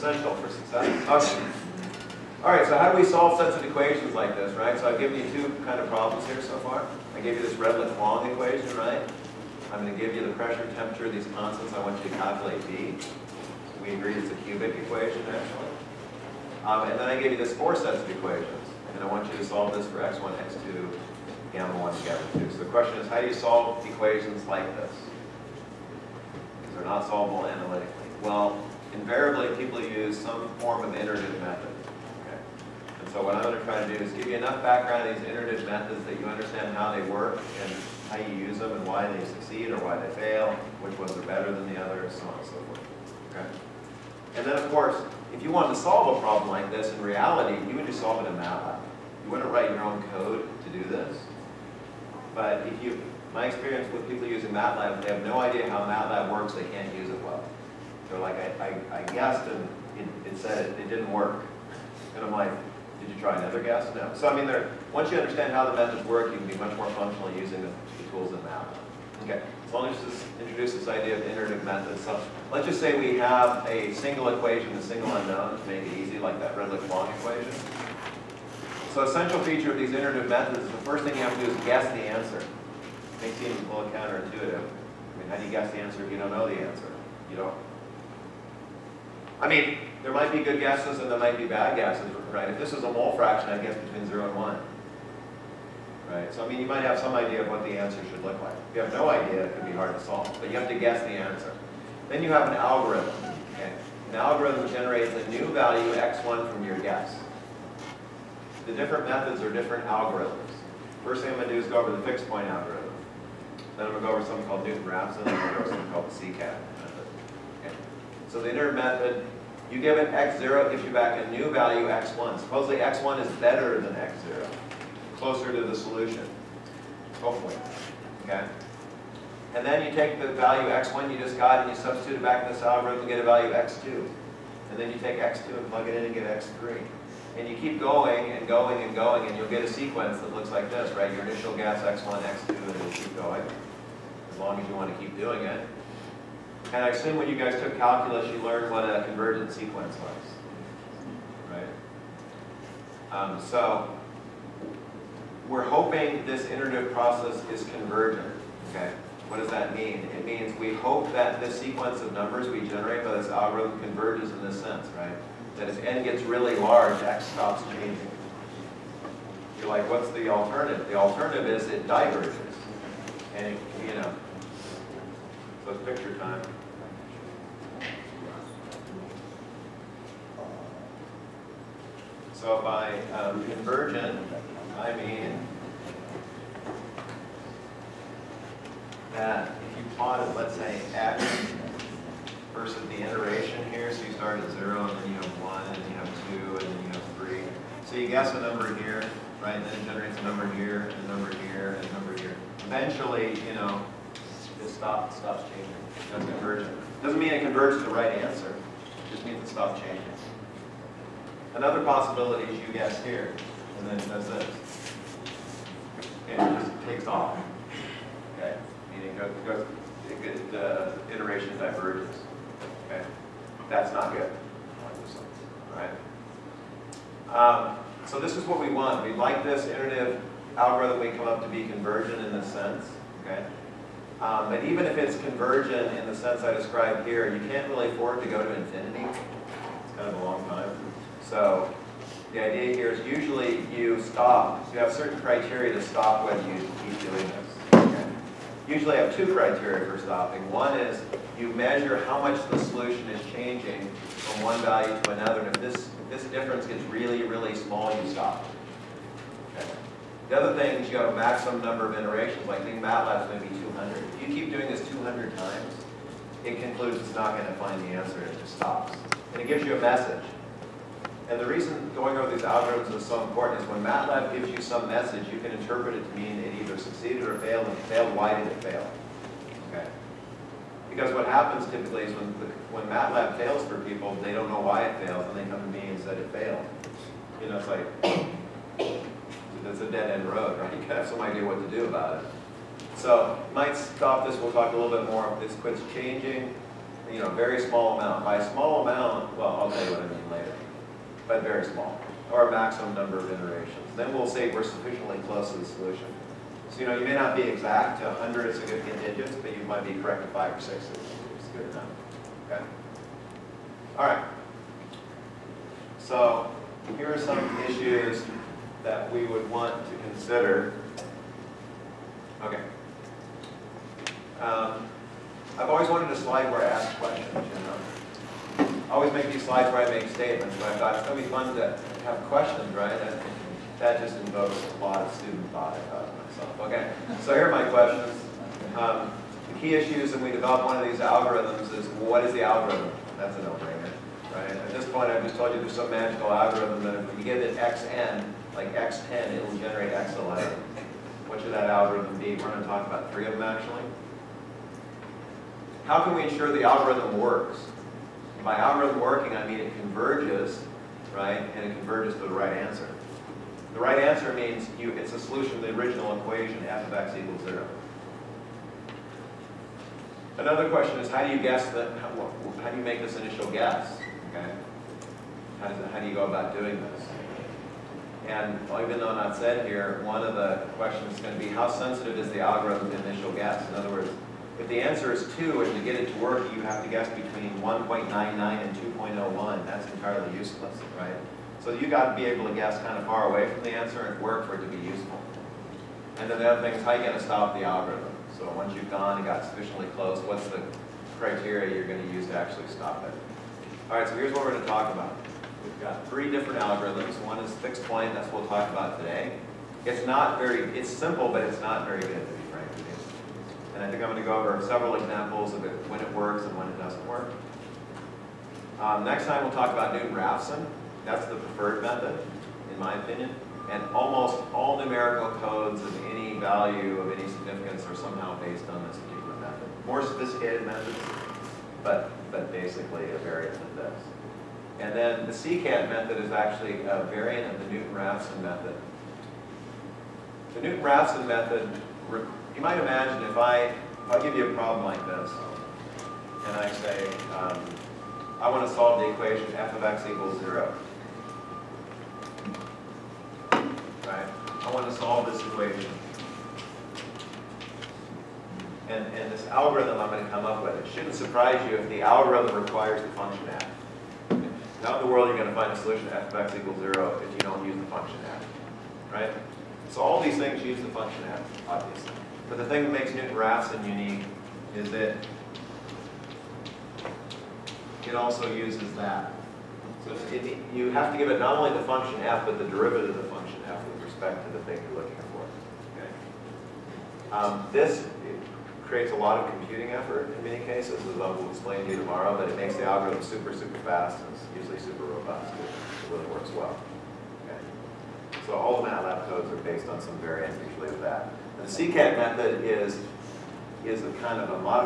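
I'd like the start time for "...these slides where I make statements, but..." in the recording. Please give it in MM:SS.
05:29.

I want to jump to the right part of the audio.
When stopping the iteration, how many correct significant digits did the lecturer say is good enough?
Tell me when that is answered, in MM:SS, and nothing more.
05:10.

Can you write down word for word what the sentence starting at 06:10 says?
Another question is, how do you guess that, how, how do you make this initial guess?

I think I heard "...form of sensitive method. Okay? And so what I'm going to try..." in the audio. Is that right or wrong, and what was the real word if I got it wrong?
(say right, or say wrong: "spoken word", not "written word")
wrong: "iterative", not "sensitive".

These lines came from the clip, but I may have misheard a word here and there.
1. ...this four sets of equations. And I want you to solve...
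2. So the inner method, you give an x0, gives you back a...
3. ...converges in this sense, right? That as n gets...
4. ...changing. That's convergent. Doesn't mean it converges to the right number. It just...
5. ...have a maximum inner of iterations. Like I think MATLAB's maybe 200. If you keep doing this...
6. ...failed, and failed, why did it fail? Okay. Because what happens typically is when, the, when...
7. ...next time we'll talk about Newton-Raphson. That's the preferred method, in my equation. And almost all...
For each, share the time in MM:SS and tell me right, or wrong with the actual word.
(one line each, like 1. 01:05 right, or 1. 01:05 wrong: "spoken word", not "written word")
1. 00:17 right
2. 01:58 right
3. 02:43 right
4. 03:25 wrong: "answer", not "number"
5. 04:20 wrong: "number", not "inner"
6. 04:37 right
7. 06:59 wrong: "opinion", not "equation".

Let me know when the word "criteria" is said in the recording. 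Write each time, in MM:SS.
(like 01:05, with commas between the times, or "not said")
04:05, 04:09, 06:41.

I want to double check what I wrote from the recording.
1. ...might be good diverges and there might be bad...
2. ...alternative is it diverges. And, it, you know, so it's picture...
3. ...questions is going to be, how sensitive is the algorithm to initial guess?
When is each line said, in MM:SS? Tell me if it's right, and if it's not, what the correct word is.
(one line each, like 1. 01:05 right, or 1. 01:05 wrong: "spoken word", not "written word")
1. 01:30 wrong: "guesses", not "diverges"
2. 02:50 right
3. 06:20 right.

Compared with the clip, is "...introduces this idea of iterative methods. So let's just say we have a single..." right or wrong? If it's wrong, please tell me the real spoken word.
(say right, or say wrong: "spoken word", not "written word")
right.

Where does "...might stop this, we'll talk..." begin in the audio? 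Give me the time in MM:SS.
04:53.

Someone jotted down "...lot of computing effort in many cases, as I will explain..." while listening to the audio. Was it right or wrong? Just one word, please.
right.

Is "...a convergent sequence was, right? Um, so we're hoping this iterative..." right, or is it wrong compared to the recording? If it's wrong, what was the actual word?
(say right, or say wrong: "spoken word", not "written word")
right.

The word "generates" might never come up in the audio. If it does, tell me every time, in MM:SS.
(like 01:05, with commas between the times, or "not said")
01:44, 02:42, 03:19, 05:49.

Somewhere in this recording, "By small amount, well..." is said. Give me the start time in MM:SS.
04:58.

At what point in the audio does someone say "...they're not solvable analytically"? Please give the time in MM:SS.
00:26.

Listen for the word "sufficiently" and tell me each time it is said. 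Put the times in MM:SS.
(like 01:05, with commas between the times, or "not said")
05:04, 06:39.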